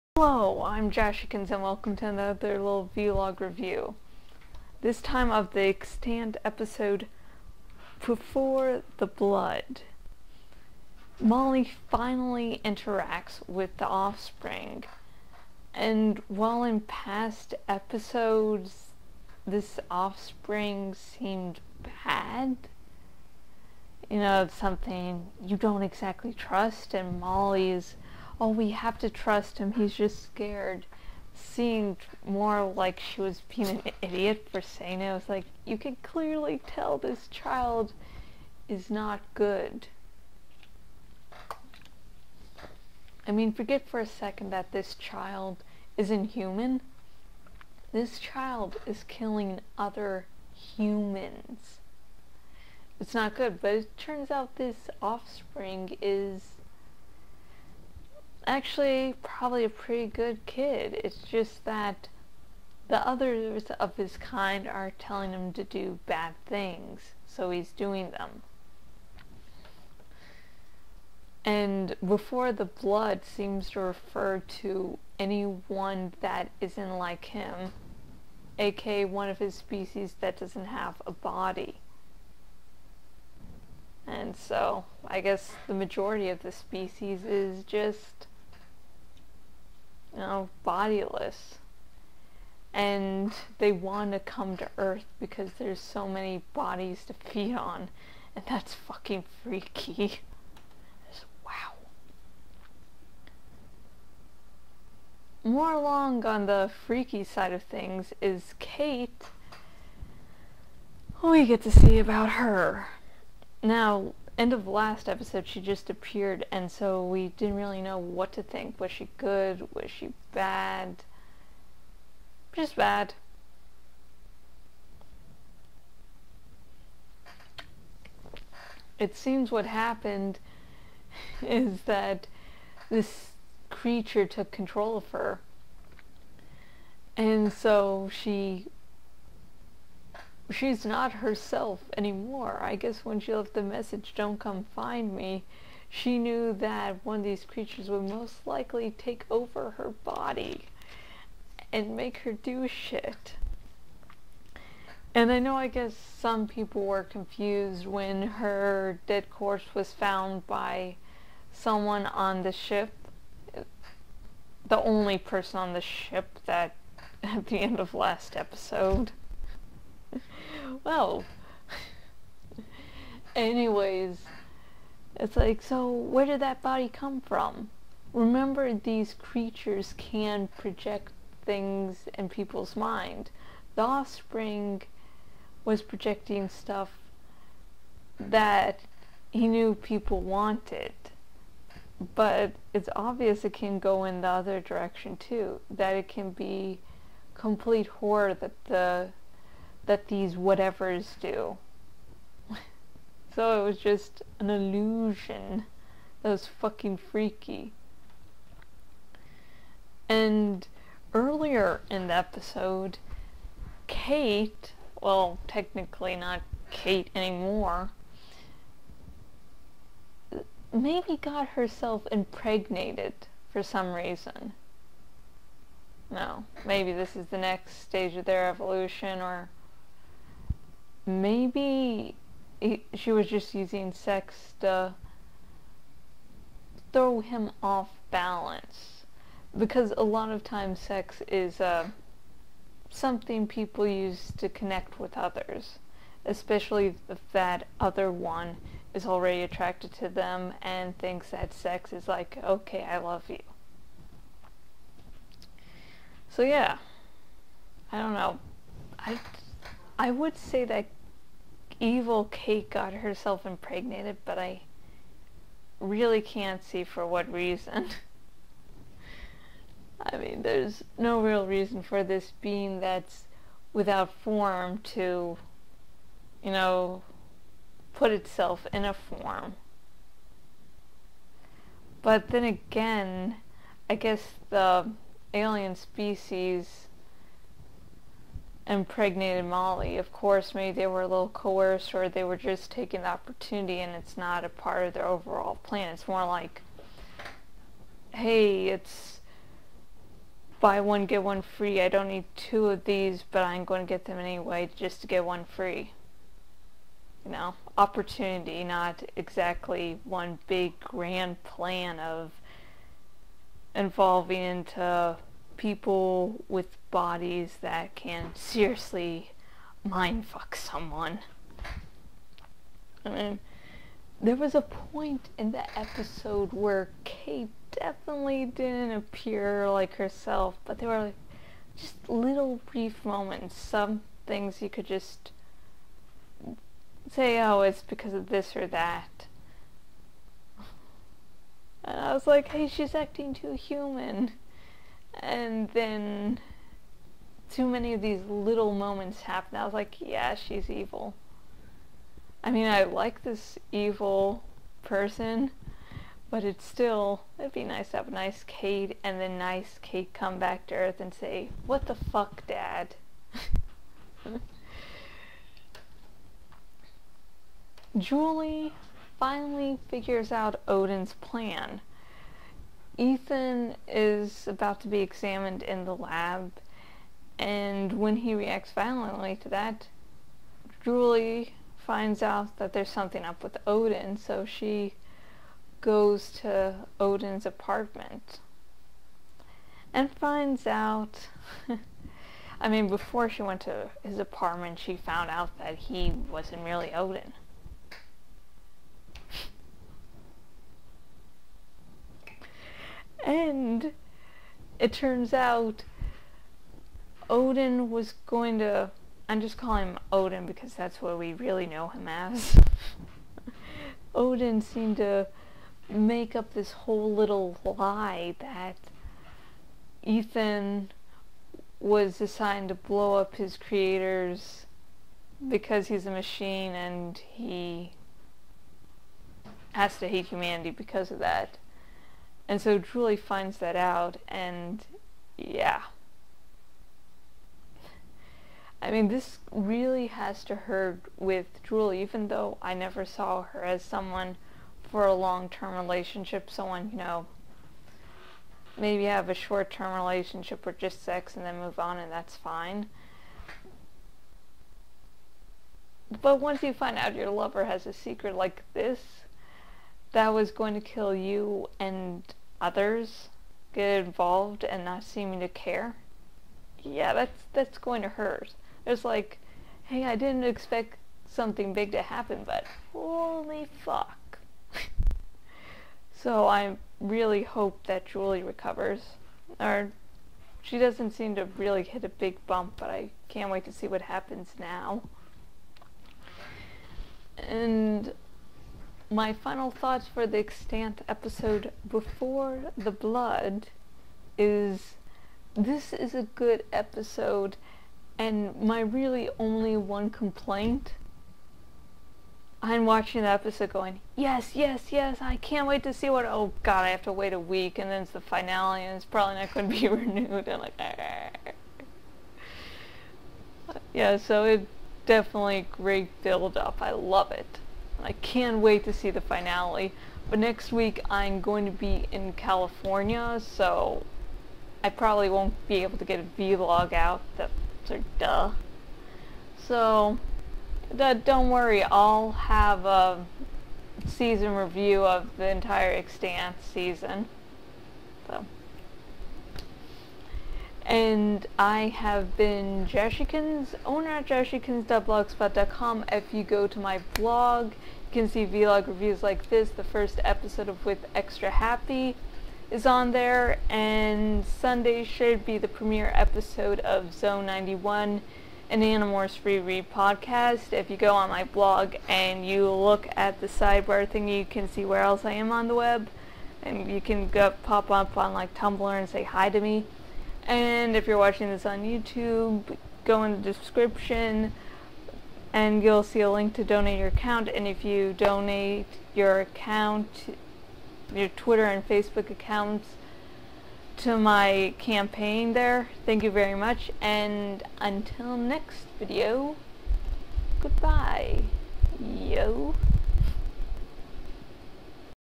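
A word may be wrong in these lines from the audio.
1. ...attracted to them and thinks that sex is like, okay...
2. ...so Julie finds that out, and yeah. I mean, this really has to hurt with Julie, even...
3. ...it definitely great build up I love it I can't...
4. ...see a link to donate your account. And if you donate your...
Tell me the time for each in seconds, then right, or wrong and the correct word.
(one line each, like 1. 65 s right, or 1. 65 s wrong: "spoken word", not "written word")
1. 249 s right
2. 432 s right
3. 514 s right
4. 576 s right.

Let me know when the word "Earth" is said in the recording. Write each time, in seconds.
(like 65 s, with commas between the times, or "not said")
94 s, 360 s.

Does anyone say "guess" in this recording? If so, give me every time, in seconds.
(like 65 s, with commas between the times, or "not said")
85 s, 142 s, 155 s, 283 s.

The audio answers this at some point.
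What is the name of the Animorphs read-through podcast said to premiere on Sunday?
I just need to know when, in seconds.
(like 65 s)
557 s.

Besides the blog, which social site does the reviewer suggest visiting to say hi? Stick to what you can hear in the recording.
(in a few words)
Tumblr.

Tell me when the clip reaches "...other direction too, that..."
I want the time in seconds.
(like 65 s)
194 s.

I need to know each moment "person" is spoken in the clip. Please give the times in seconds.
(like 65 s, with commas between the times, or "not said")
165 s, 354 s.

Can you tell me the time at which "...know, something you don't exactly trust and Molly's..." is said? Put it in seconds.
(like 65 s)
24 s.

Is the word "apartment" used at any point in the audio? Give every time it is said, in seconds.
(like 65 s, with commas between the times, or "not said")
387 s, 394 s.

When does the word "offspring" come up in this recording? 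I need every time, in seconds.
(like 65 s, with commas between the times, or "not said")
13 s, 19 s, 54 s, 183 s.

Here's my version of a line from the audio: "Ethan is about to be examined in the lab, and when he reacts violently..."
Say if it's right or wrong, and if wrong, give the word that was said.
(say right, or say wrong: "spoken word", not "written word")
right.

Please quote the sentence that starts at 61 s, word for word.
It's just that the others of his kind are telling him to do bad things, so he's doing them.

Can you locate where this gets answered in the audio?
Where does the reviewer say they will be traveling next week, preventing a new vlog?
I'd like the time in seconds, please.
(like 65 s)
522 s.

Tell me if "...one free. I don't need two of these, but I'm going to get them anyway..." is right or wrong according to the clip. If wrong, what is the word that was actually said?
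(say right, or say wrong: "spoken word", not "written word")
right.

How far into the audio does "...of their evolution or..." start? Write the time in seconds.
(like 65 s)
228 s.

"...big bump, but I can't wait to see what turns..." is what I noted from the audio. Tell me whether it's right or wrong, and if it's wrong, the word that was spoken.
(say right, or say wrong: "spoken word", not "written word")
wrong: "happens", not "turns".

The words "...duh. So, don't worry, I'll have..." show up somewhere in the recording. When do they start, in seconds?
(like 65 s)
528 s.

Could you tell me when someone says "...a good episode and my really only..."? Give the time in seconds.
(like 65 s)
496 s.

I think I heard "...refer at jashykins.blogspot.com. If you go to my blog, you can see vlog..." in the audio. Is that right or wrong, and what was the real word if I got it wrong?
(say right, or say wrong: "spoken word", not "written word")
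wrong: "owner", not "refer".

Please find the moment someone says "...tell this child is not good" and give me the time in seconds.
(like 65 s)
36 s.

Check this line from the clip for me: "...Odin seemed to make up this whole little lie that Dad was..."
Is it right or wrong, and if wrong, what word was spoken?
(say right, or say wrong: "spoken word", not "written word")
wrong: "Ethan", not "Dad".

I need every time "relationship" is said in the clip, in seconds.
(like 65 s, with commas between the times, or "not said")
445 s, 449 s.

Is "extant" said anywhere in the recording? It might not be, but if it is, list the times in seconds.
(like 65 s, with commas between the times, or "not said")
5 s, 490 s, 535 s.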